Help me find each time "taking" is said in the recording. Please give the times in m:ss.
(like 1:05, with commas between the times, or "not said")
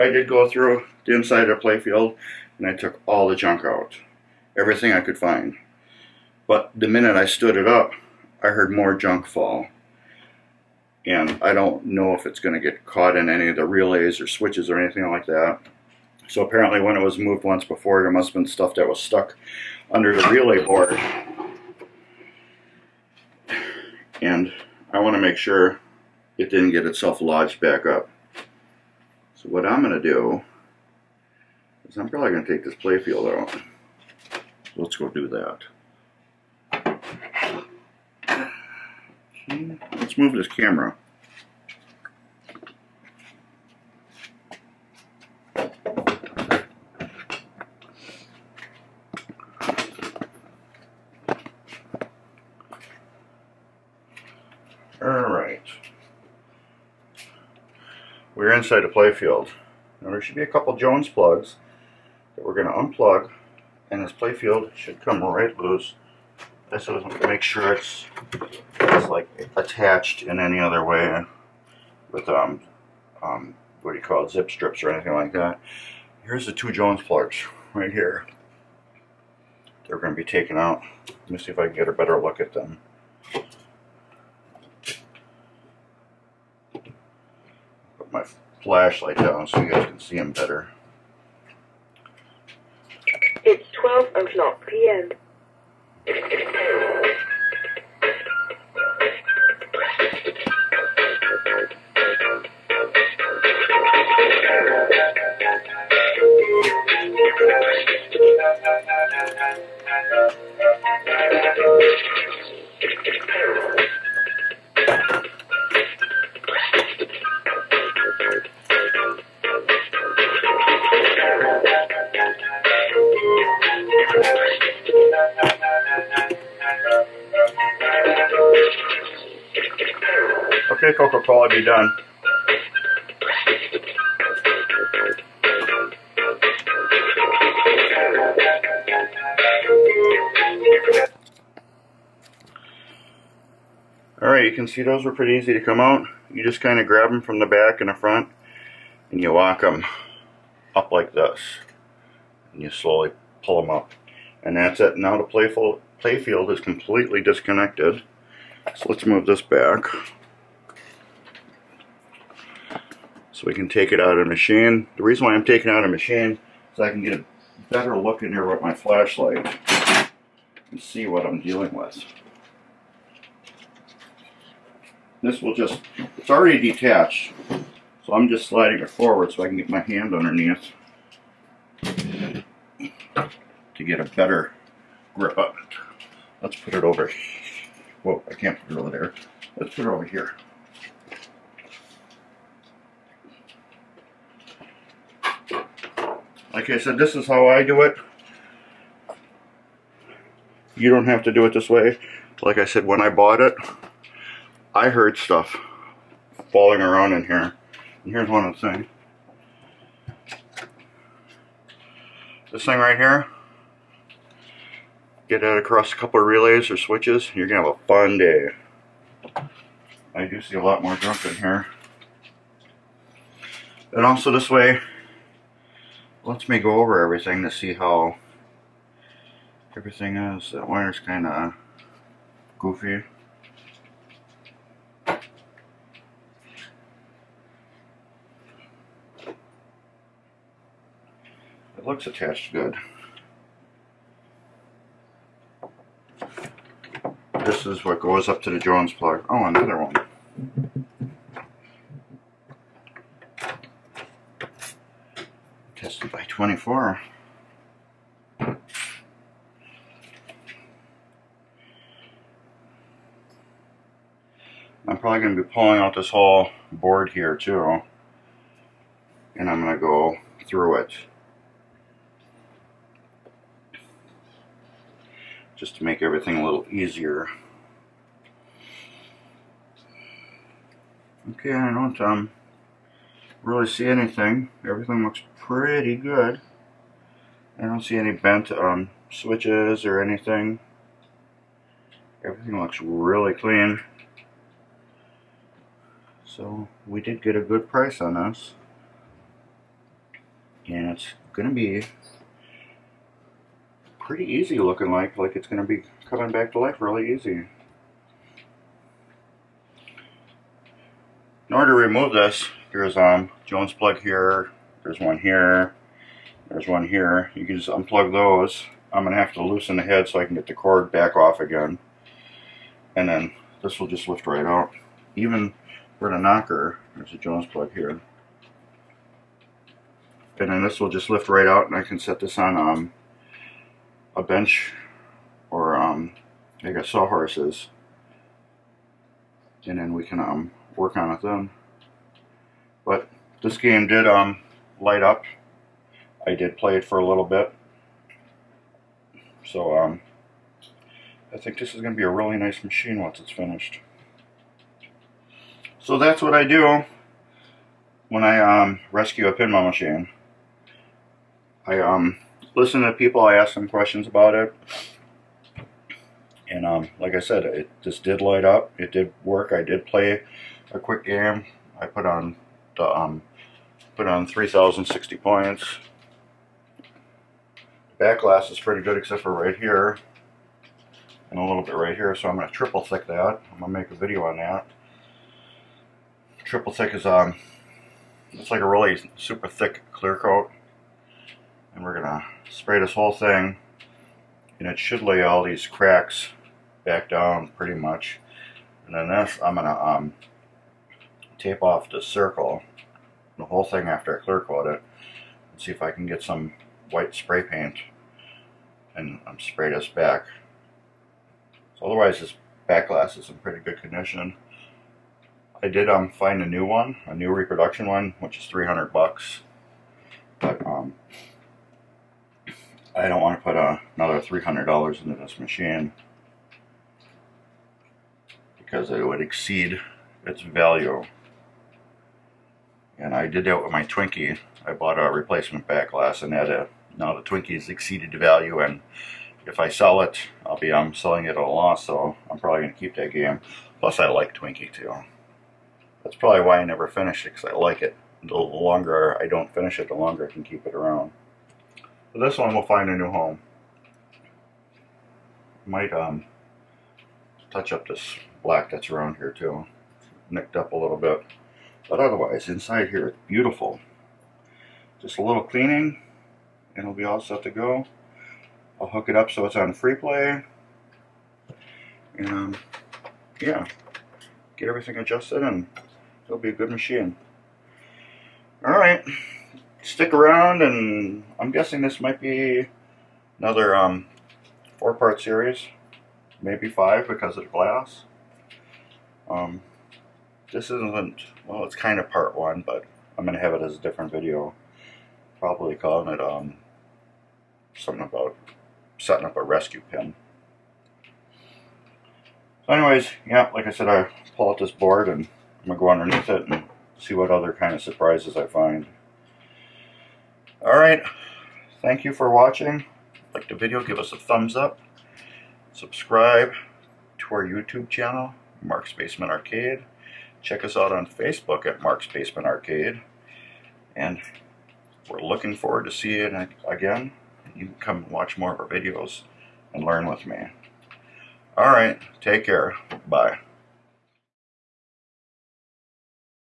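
2:45.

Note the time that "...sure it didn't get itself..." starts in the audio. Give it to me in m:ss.
0:25.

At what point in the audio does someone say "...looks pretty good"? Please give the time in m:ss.
4:45.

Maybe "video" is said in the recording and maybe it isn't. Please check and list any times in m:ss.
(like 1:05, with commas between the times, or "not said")
6:23, 8:14, 8:33, 8:48.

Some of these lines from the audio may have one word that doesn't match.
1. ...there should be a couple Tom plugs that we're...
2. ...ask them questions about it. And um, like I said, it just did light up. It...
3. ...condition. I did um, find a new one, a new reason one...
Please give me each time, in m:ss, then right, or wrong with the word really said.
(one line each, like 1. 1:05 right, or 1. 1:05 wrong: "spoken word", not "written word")
1. 1:00 wrong: "Jones", not "Tom"
2. 6:03 right
3. 6:53 wrong: "reproduction", not "reason".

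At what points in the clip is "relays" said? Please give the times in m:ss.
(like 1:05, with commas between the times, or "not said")
0:13, 0:20, 3:36.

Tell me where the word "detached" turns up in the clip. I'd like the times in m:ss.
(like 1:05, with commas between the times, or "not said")
2:56.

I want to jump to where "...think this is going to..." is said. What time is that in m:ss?
5:51.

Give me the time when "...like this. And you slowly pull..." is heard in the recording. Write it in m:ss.
2:30.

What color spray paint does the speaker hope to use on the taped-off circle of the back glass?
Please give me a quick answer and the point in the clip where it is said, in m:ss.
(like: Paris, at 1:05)
White, at 6:46.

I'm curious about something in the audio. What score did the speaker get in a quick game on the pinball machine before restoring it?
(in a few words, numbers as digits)
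3,060 points.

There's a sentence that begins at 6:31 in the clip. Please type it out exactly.
And we're going to spray this whole thing, and it should lay all these cracks back down pretty much.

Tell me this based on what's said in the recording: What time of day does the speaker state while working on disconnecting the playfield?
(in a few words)
12 o'clock p.m.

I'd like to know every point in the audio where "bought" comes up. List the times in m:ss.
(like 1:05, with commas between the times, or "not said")
3:23, 7:14.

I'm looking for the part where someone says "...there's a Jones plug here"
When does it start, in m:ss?
5:26.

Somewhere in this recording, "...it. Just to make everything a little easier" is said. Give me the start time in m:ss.
4:30.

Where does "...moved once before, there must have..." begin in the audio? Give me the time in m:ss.
0:17.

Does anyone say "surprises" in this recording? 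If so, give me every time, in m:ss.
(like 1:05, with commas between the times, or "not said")
8:27.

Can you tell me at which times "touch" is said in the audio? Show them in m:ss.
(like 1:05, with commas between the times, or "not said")
7:37.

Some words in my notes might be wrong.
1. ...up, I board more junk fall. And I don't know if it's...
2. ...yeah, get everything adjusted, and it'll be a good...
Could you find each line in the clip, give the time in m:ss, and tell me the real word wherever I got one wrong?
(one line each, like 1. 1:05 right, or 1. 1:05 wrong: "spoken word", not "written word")
1. 0:07 wrong: "heard", not "board"
2. 7:53 right.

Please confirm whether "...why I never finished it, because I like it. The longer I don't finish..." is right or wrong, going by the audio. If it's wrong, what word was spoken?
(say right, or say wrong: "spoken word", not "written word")
right.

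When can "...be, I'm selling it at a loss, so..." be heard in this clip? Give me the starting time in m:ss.
7:20.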